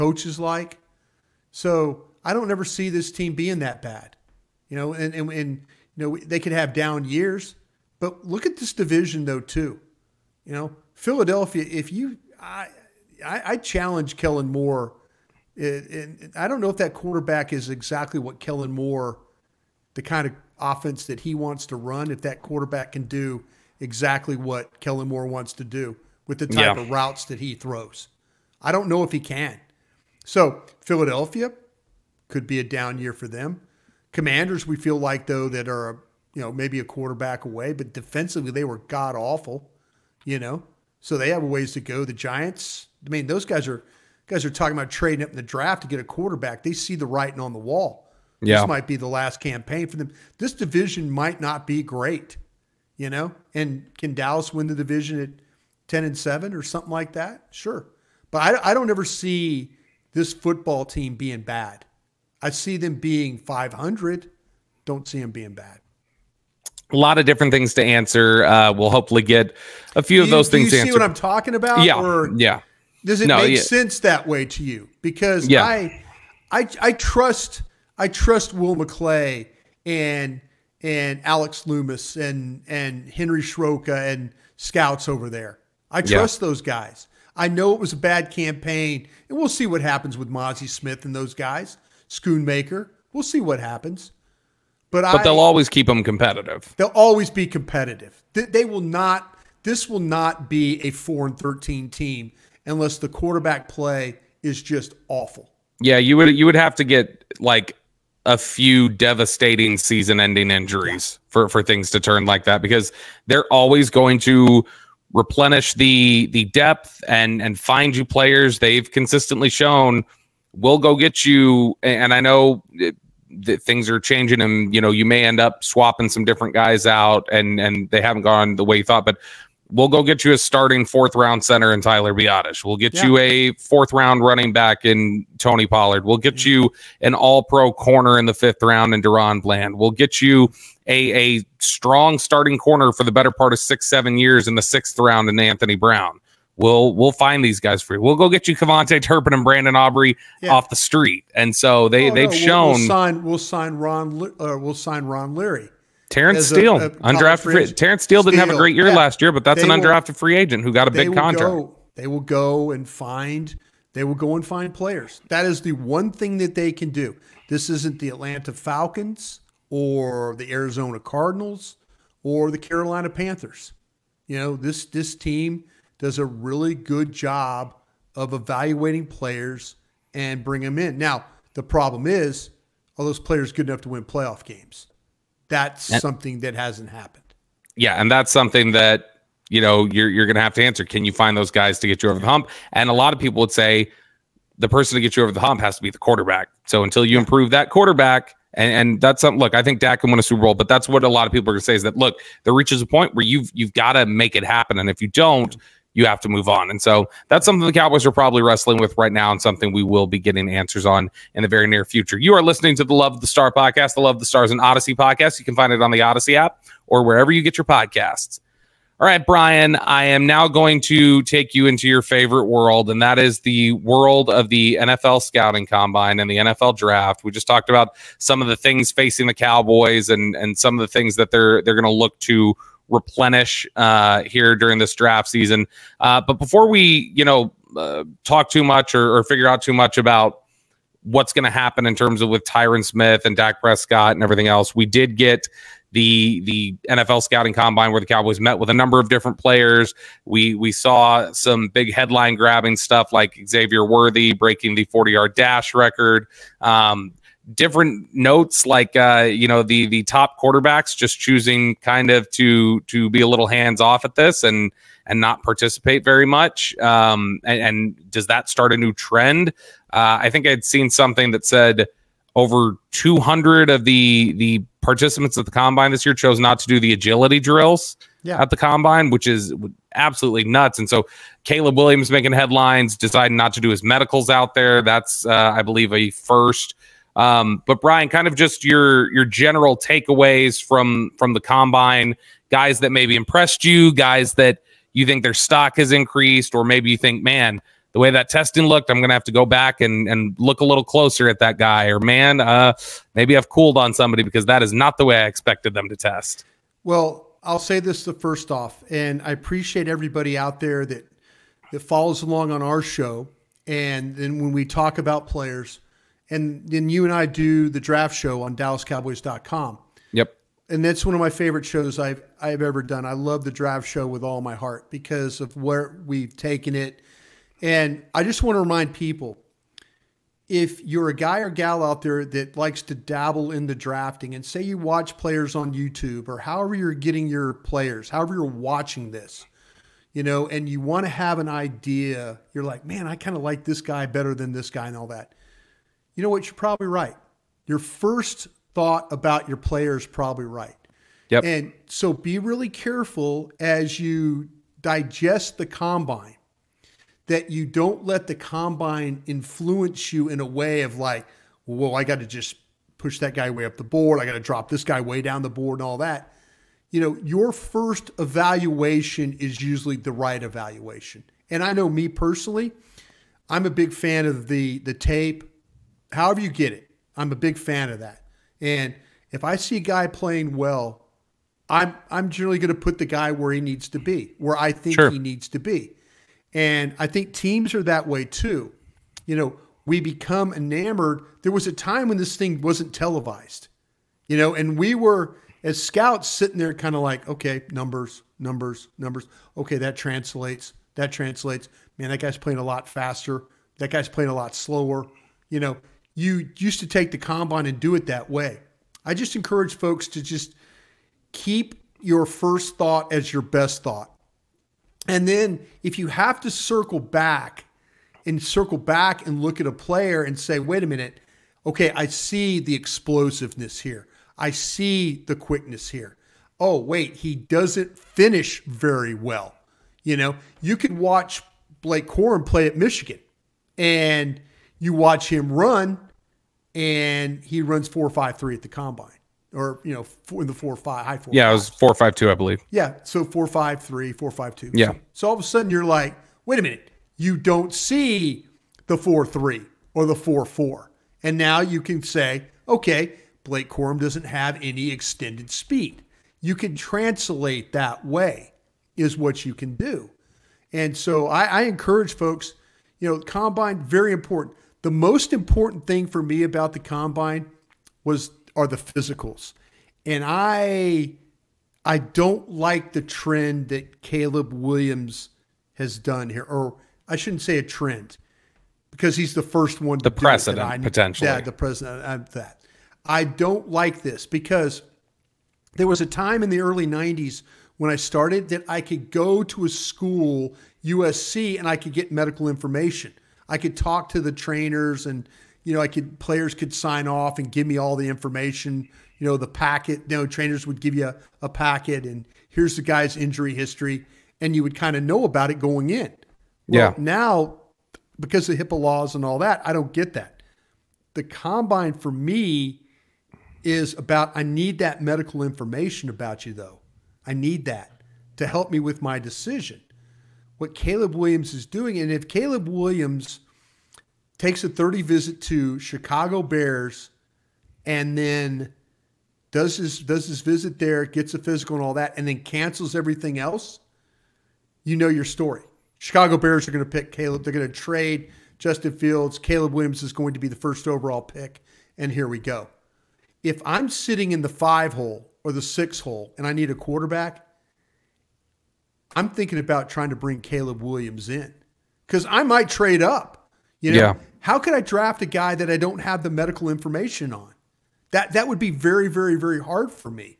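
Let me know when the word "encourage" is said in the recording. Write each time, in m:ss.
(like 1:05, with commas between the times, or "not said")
6:49, 7:41.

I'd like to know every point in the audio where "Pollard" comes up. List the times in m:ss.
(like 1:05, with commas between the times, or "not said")
2:15.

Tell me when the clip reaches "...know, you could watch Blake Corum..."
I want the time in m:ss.
7:10.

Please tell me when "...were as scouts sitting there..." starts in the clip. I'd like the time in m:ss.
6:34.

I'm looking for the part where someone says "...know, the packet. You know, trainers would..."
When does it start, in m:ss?
8:19.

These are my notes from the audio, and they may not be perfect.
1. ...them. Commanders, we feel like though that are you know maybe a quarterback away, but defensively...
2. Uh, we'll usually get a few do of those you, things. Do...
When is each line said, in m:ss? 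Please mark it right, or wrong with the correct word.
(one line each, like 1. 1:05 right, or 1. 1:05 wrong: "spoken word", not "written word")
1. 0:33 right
2. 1:08 wrong: "hopefully", not "usually".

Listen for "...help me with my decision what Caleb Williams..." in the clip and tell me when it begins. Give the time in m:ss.
8:38.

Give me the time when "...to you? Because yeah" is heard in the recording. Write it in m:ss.
1:14.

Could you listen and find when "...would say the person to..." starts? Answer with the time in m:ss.
3:13.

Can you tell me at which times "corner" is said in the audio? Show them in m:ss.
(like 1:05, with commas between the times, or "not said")
2:17, 2:22.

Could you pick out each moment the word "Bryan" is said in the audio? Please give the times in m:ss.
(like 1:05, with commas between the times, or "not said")
3:39, 4:47.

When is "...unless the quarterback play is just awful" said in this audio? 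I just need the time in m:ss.
1:42.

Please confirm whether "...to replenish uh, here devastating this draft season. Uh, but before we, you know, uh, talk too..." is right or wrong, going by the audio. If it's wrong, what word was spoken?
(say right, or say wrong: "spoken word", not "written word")
wrong: "during", not "devastating".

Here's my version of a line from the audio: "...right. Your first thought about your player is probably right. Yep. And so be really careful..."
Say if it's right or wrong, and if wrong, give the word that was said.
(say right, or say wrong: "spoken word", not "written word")
right.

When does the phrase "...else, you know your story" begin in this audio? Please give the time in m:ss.
8:53.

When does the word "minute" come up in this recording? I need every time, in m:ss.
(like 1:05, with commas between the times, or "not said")
7:00, 7:26.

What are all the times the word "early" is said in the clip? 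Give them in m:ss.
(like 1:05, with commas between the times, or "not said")
8:06.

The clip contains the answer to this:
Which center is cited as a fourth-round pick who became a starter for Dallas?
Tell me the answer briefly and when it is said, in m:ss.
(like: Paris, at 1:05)
Tyler Biadasz, at 2:11.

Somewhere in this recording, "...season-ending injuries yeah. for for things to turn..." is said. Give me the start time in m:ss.
1:49.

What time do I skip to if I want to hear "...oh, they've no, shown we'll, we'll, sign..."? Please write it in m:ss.
2:32.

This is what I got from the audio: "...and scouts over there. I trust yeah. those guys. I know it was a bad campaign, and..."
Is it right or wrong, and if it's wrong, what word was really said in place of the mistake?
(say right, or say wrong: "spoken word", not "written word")
right.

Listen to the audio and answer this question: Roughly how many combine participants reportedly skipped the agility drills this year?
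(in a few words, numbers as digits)
over 200.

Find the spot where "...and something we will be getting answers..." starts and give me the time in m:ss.
3:29.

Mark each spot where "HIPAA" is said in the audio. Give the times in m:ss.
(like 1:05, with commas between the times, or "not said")
8:28.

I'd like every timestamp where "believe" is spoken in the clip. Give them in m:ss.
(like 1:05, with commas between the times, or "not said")
4:45, 7:22.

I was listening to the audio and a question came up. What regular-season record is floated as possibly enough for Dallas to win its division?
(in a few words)
10 and 7.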